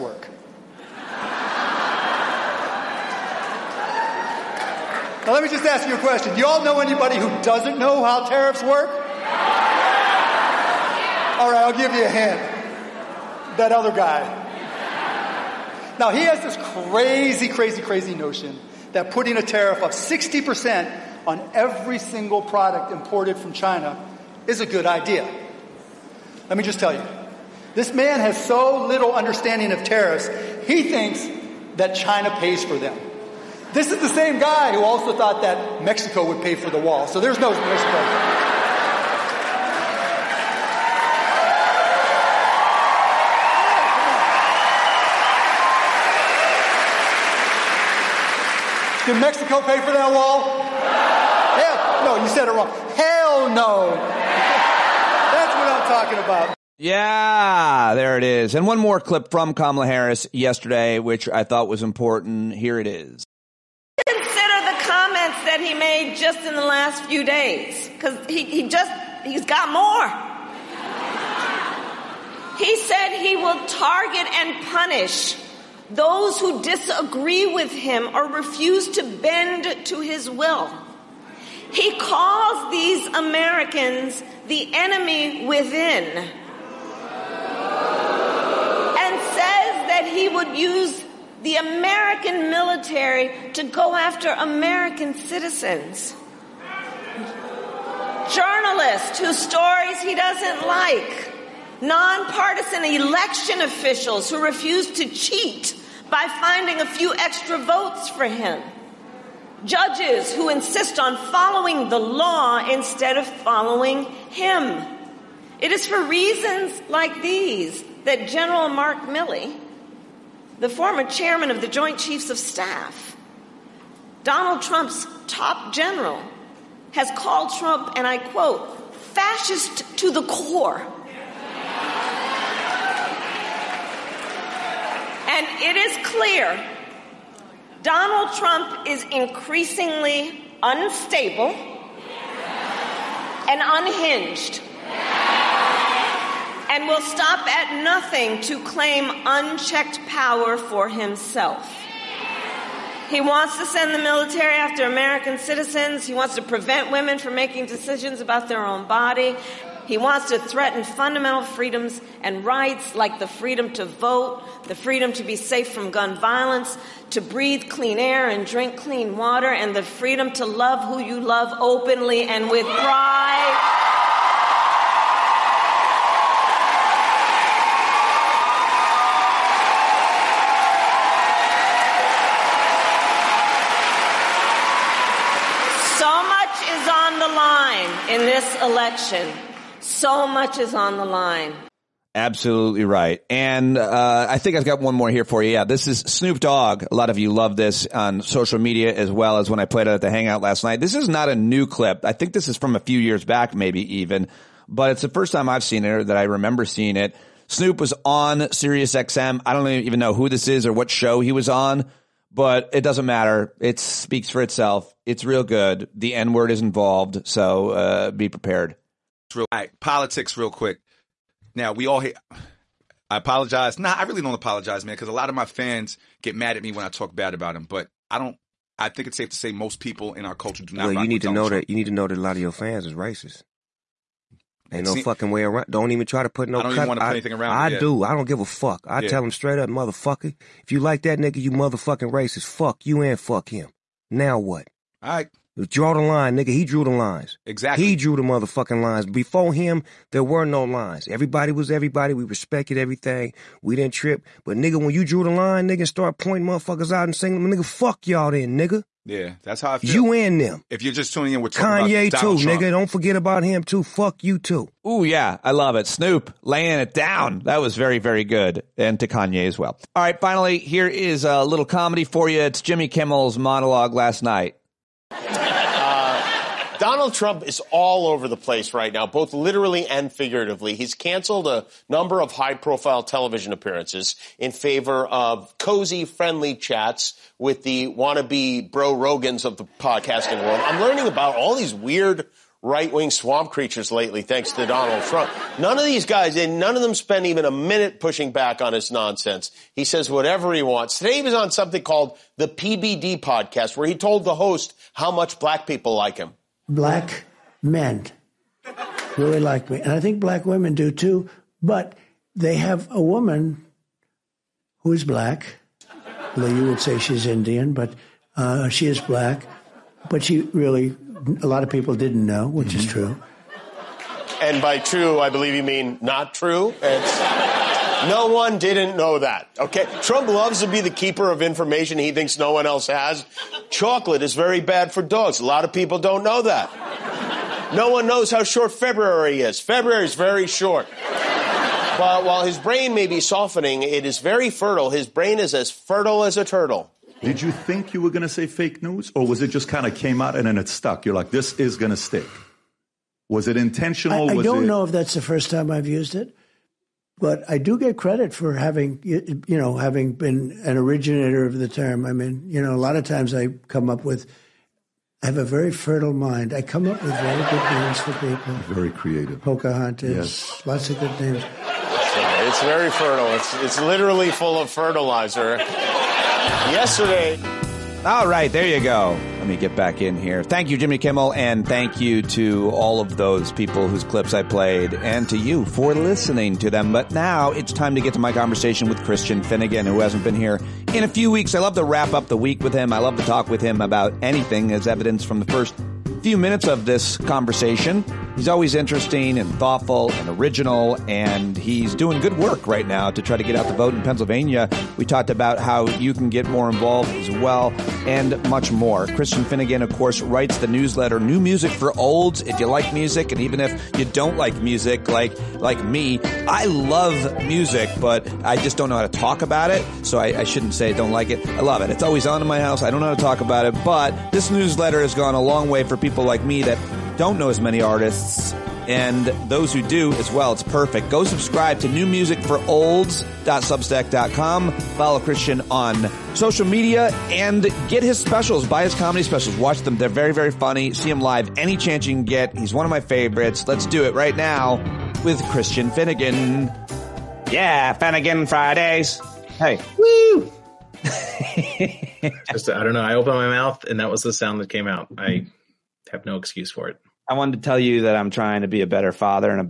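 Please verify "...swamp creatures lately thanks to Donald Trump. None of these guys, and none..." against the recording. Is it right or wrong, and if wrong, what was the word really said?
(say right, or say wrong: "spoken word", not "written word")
right.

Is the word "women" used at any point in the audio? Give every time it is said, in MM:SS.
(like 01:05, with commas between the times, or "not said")
02:36, 05:10.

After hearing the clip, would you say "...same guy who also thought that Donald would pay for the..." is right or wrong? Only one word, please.
wrong.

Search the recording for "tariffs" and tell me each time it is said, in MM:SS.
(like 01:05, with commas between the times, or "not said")
00:08, 00:19, 00:29.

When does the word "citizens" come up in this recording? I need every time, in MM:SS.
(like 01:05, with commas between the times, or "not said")
01:35, 02:35.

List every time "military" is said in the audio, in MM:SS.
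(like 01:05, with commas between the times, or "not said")
01:32, 02:33.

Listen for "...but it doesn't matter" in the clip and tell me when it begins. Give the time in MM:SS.
03:32.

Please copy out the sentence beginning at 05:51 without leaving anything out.
You're like, this is going to stick.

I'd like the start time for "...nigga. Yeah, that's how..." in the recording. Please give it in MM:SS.
04:18.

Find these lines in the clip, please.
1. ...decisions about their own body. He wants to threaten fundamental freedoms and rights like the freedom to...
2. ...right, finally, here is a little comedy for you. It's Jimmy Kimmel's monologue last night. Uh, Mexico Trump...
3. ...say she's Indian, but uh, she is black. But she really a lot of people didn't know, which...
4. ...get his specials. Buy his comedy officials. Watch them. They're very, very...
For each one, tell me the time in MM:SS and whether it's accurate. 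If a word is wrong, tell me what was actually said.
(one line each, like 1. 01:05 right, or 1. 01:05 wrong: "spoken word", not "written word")
1. 02:37 right
2. 04:30 wrong: "Donald", not "Mexico"
3. 05:16 right
4. 07:17 wrong: "specials", not "officials".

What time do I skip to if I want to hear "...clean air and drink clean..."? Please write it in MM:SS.
02:47.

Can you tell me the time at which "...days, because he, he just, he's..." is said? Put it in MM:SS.
01:07.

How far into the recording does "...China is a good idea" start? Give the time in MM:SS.
00:23.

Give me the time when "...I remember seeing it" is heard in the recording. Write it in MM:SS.
03:26.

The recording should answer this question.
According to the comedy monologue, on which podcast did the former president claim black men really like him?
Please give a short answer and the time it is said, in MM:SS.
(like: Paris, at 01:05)
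PBD podcast, at 05:02.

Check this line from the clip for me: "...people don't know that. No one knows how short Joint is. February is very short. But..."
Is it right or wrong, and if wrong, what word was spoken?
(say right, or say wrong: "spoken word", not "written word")
wrong: "February", not "Joint".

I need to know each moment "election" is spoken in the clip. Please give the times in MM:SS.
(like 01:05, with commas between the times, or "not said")
01:42, 03:08.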